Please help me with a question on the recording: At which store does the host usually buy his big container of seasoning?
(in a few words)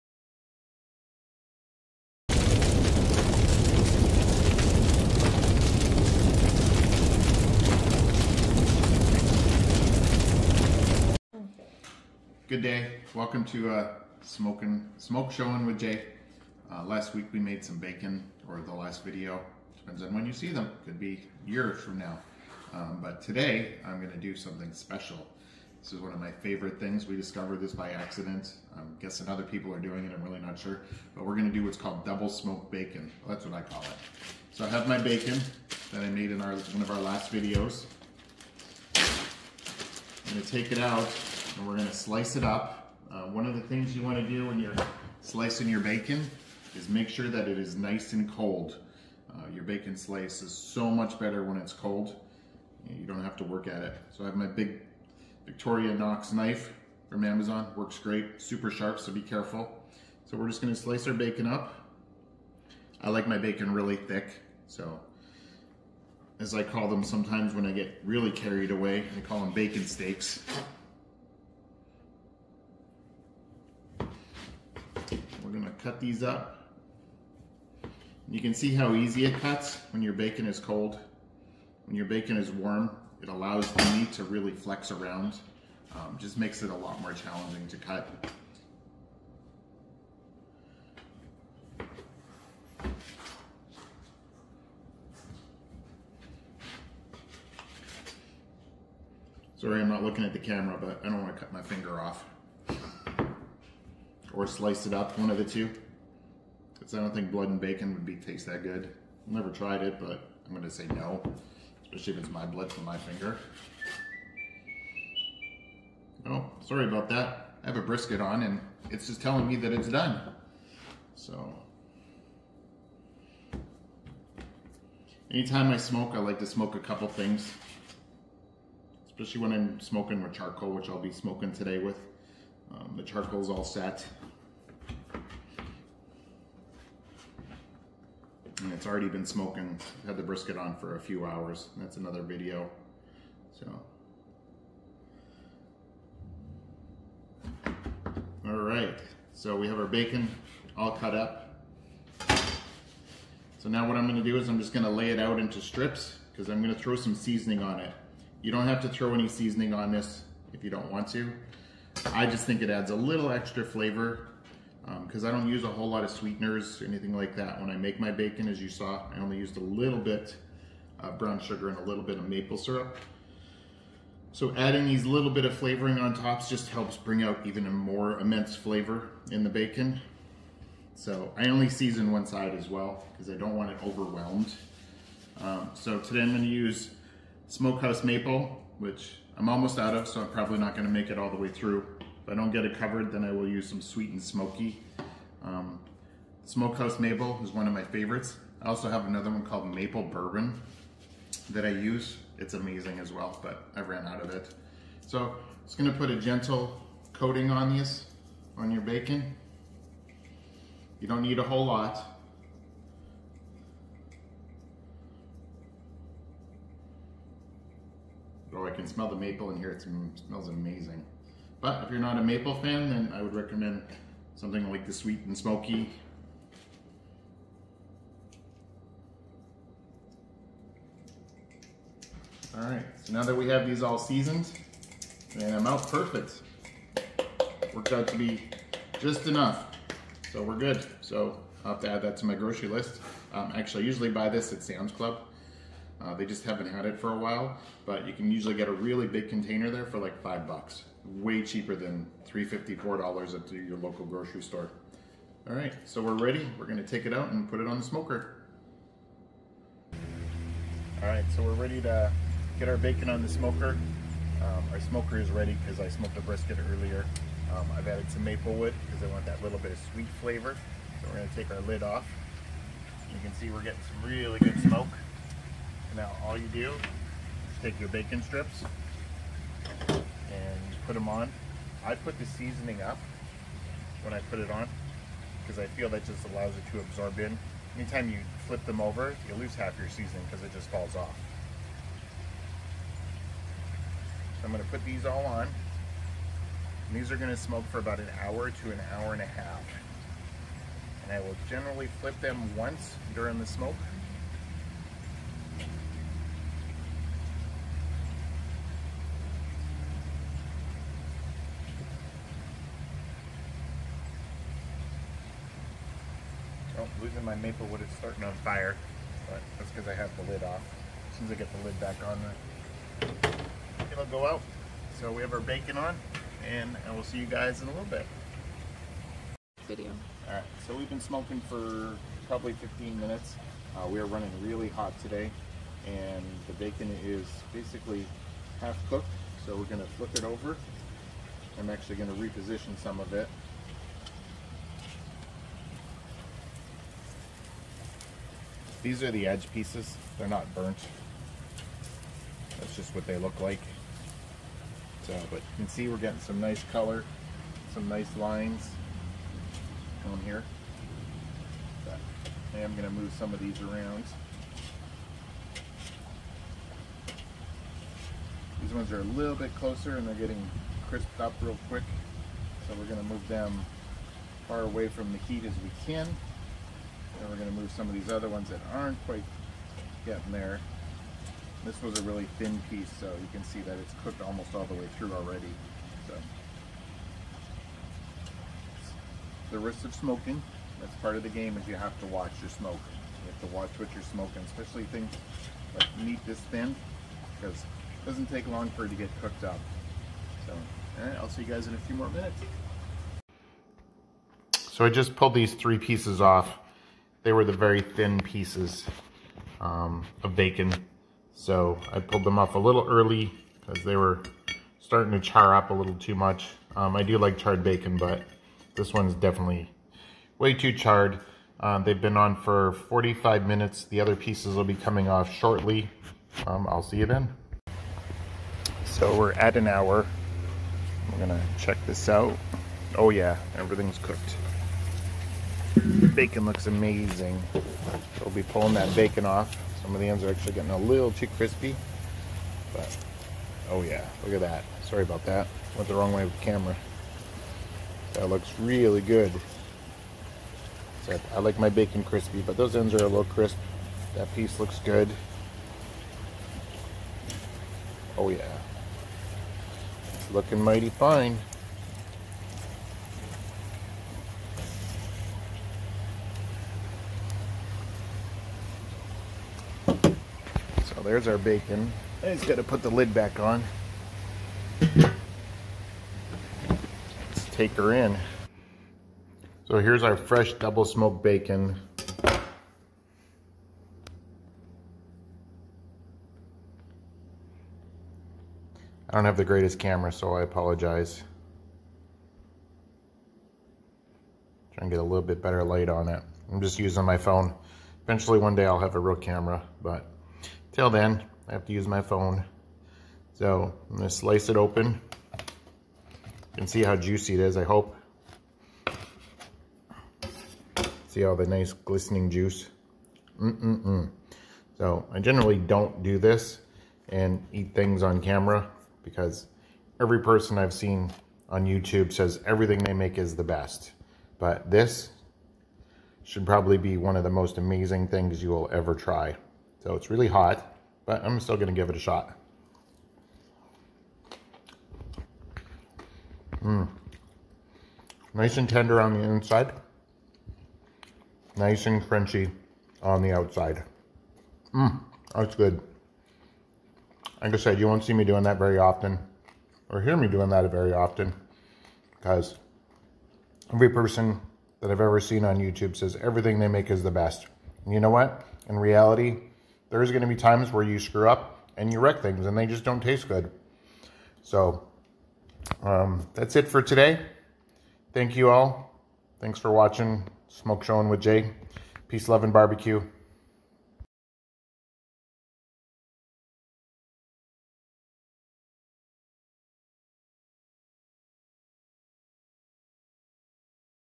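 Sam's Club.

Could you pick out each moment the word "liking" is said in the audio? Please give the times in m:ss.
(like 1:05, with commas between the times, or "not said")
not said.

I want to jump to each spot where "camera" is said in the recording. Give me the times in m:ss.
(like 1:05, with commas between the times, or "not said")
1:40, 7:26, 8:09, 8:19, 8:38.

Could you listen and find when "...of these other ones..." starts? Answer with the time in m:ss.
6:17.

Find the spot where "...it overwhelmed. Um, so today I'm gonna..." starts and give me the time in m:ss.
3:03.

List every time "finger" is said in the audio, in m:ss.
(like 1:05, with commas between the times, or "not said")
1:41, 1:52.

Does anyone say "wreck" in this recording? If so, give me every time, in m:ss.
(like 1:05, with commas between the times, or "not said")
9:21.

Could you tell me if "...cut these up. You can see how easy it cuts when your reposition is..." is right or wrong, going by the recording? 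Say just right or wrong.
wrong.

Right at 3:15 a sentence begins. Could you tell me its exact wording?
Um, Smokehouse Maple is one of my favorites.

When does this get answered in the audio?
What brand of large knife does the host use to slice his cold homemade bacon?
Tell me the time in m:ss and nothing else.
0:55.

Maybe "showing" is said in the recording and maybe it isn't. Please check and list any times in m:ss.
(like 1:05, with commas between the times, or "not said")
0:15, 9:30.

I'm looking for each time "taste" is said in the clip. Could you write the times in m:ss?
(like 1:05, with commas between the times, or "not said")
1:48, 9:23.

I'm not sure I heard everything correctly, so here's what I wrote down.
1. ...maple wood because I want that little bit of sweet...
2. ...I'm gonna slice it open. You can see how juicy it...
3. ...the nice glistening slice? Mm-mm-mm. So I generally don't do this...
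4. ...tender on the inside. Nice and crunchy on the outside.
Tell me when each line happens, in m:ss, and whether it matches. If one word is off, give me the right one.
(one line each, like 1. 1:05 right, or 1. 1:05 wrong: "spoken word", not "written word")
1. 4:28 right
2. 8:23 right
3. 8:31 wrong: "juice", not "slice"
4. 8:58 right.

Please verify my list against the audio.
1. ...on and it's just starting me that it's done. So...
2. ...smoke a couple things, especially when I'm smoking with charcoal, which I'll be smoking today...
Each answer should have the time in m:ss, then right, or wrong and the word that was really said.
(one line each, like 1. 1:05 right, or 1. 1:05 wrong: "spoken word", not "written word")
1. 1:58 wrong: "telling", not "starting"
2. 2:06 right.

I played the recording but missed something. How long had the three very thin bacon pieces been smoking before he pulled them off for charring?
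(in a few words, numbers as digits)
45 minutes.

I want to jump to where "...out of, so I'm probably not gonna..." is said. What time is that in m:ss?
3:09.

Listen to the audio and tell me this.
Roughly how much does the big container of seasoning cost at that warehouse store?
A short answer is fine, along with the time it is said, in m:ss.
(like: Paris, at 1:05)
5 dollars, at 4:10.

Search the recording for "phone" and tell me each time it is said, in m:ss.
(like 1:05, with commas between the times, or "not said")
8:17, 8:22.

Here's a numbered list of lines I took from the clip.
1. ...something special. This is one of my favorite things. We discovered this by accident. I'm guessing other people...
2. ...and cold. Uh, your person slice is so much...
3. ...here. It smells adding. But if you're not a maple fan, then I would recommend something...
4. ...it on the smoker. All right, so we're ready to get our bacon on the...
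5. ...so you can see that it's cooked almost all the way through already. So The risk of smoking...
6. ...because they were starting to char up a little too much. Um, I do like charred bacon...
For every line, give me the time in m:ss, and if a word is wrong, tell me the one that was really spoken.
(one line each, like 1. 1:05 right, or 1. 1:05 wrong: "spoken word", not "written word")
1. 0:24 right
2. 0:48 wrong: "bacon", not "person"
3. 3:39 wrong: "amazing", not "adding"
4. 4:17 right
5. 6:22 right
6. 6:53 right.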